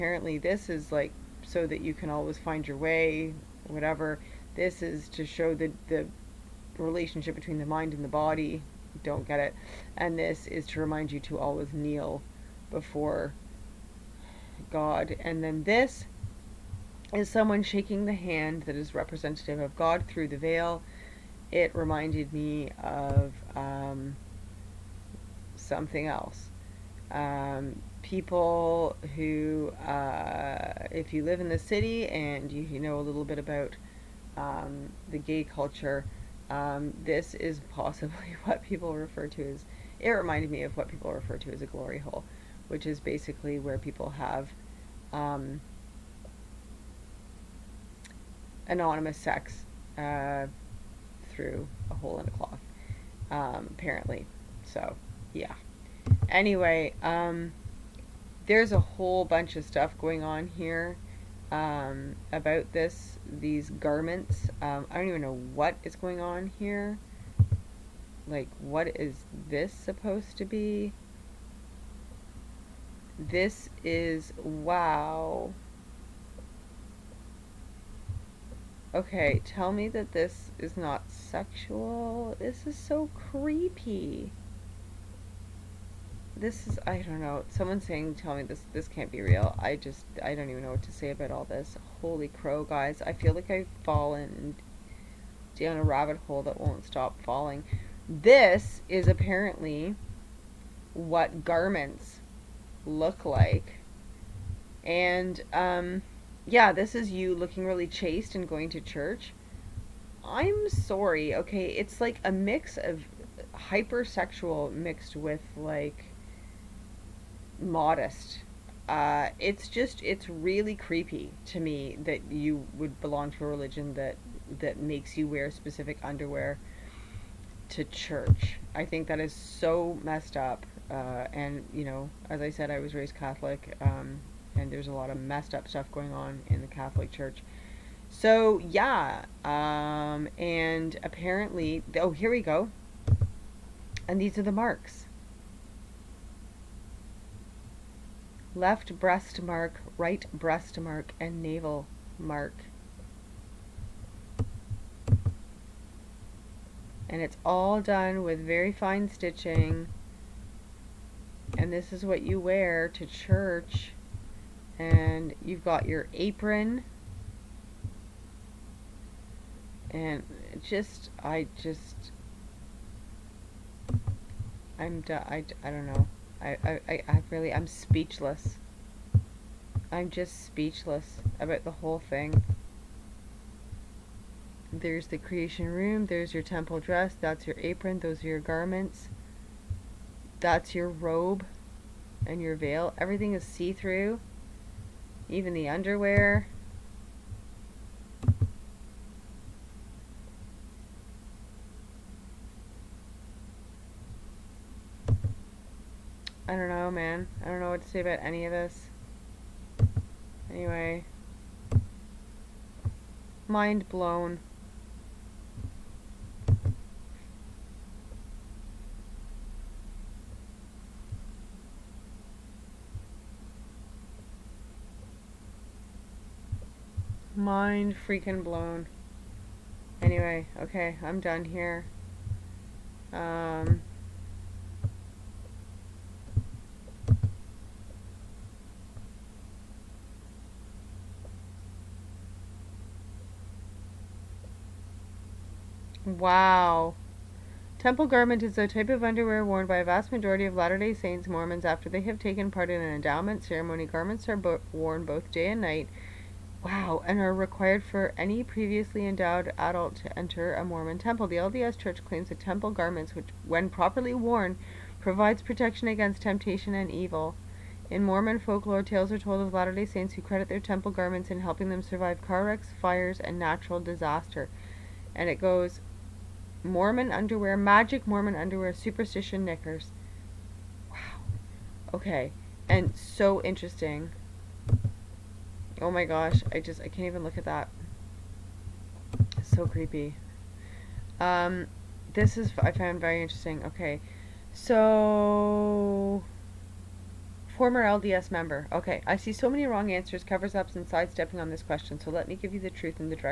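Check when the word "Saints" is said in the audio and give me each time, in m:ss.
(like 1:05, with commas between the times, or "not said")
4:10, 4:29.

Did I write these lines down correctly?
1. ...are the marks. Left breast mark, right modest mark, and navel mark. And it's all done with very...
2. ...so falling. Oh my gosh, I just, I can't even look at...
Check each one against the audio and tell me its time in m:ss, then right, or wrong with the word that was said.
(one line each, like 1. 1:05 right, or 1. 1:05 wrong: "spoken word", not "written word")
1. 2:24 wrong: "breast", not "modest"
2. 4:42 wrong: "interesting", not "falling".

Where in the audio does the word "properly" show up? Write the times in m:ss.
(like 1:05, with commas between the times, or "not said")
4:23.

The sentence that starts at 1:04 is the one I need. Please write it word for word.
Um, I don't even know what is going on here.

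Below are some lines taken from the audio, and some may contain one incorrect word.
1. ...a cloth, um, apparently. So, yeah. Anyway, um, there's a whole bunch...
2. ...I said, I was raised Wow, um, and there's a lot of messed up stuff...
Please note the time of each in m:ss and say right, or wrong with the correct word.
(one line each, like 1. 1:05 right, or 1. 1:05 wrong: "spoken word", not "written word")
1. 0:52 right
2. 2:12 wrong: "Catholic", not "Wow".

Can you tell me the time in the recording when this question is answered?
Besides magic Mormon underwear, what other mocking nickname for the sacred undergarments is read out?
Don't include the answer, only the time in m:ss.
4:38.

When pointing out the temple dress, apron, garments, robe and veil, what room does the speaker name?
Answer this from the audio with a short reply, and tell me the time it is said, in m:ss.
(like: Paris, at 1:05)
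Creation room, at 3:05.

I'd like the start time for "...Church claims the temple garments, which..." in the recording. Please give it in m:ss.
4:21.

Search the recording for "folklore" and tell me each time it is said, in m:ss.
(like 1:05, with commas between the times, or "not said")
4:28.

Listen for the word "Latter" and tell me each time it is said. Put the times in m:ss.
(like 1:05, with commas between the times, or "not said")
4:10, 4:29.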